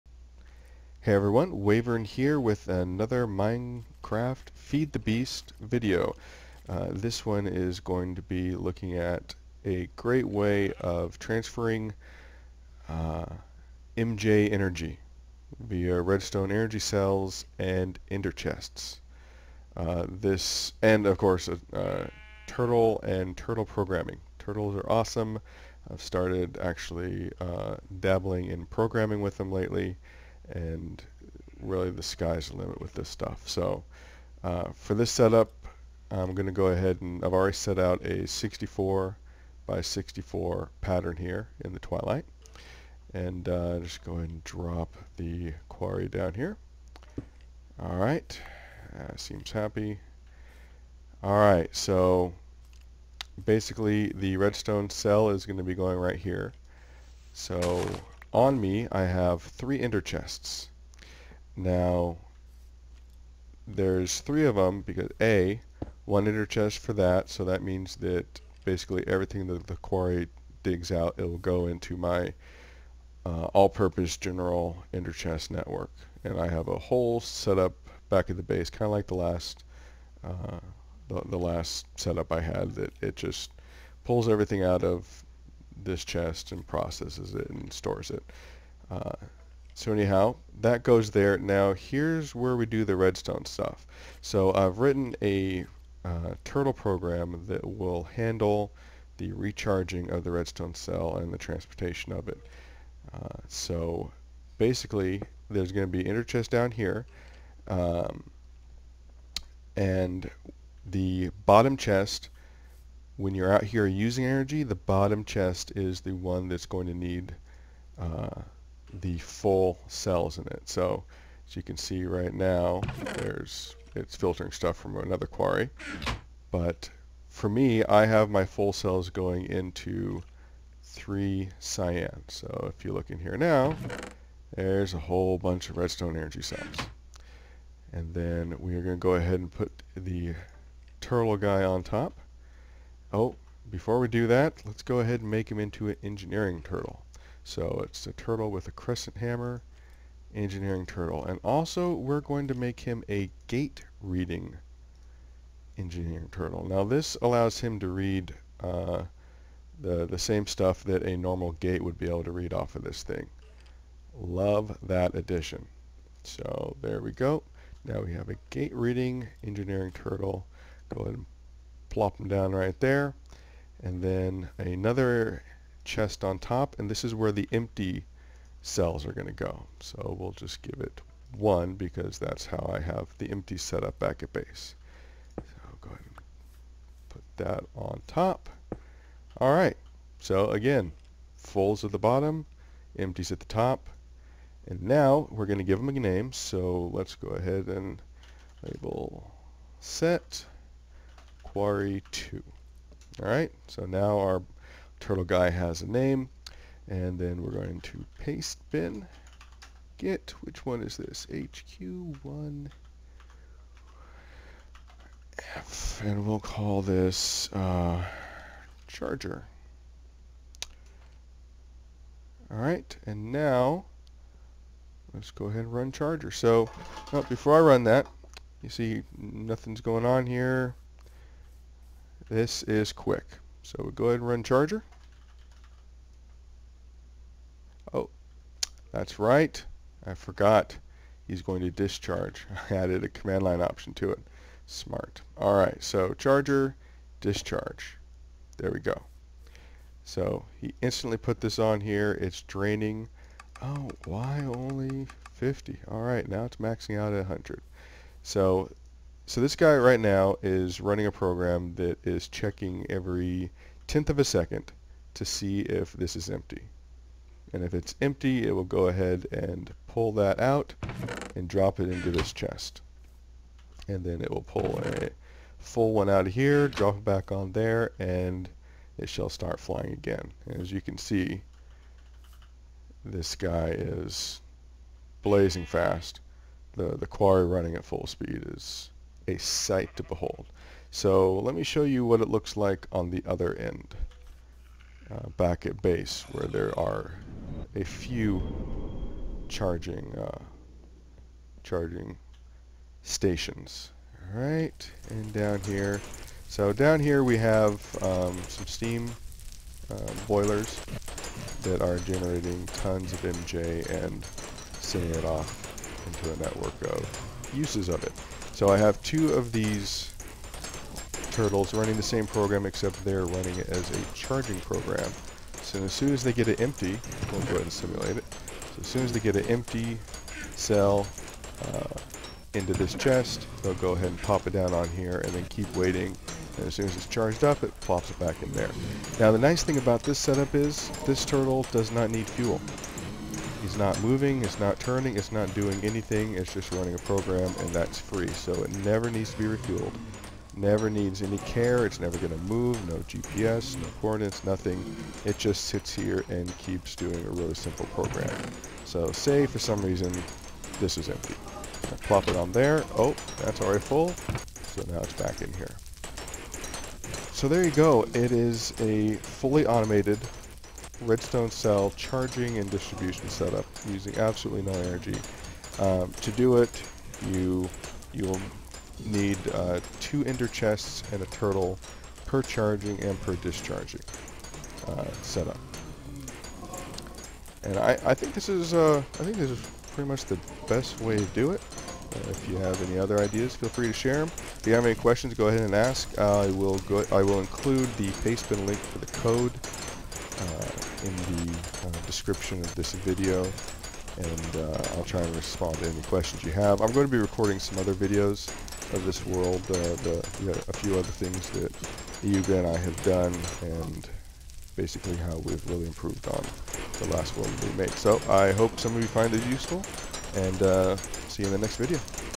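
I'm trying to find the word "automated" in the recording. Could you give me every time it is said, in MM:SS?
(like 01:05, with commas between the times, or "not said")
06:09.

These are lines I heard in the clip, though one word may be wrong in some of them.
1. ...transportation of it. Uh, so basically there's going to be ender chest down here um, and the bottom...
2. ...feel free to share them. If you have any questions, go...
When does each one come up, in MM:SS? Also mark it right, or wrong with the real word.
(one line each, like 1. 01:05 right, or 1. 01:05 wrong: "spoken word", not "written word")
1. 01:41 right
2. 06:33 right.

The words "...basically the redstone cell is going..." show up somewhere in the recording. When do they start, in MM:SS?
00:53.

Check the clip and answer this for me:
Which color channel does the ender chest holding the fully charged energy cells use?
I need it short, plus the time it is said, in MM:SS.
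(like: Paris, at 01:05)
three cyan, at 02:10.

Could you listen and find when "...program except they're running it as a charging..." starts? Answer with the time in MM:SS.
05:22.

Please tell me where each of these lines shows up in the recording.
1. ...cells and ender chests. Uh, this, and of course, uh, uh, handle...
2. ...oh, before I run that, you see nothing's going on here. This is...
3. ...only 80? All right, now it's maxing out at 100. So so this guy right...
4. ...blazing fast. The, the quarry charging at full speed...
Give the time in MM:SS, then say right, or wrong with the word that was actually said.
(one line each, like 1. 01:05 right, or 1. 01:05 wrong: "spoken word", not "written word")
1. 00:16 wrong: "turtle", not "handle"
2. 03:47 right
3. 04:14 wrong: "50", not "80"
4. 04:45 wrong: "running", not "charging".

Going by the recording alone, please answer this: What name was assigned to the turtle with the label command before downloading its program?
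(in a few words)
Quarry 2.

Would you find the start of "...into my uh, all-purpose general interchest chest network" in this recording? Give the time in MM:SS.
01:11.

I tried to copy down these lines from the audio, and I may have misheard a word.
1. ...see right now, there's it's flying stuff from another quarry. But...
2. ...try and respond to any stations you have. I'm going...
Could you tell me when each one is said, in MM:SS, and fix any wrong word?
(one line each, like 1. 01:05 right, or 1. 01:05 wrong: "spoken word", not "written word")
1. 02:01 wrong: "filtering", not "flying"
2. 06:45 wrong: "questions", not "stations".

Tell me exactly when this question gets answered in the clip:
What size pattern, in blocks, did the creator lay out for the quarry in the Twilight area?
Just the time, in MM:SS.
00:38.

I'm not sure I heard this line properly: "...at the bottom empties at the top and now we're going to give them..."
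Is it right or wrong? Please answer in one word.
right.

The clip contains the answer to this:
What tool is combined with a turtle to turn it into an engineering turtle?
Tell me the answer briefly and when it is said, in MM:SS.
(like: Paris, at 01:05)
crescent hammer, at 02:28.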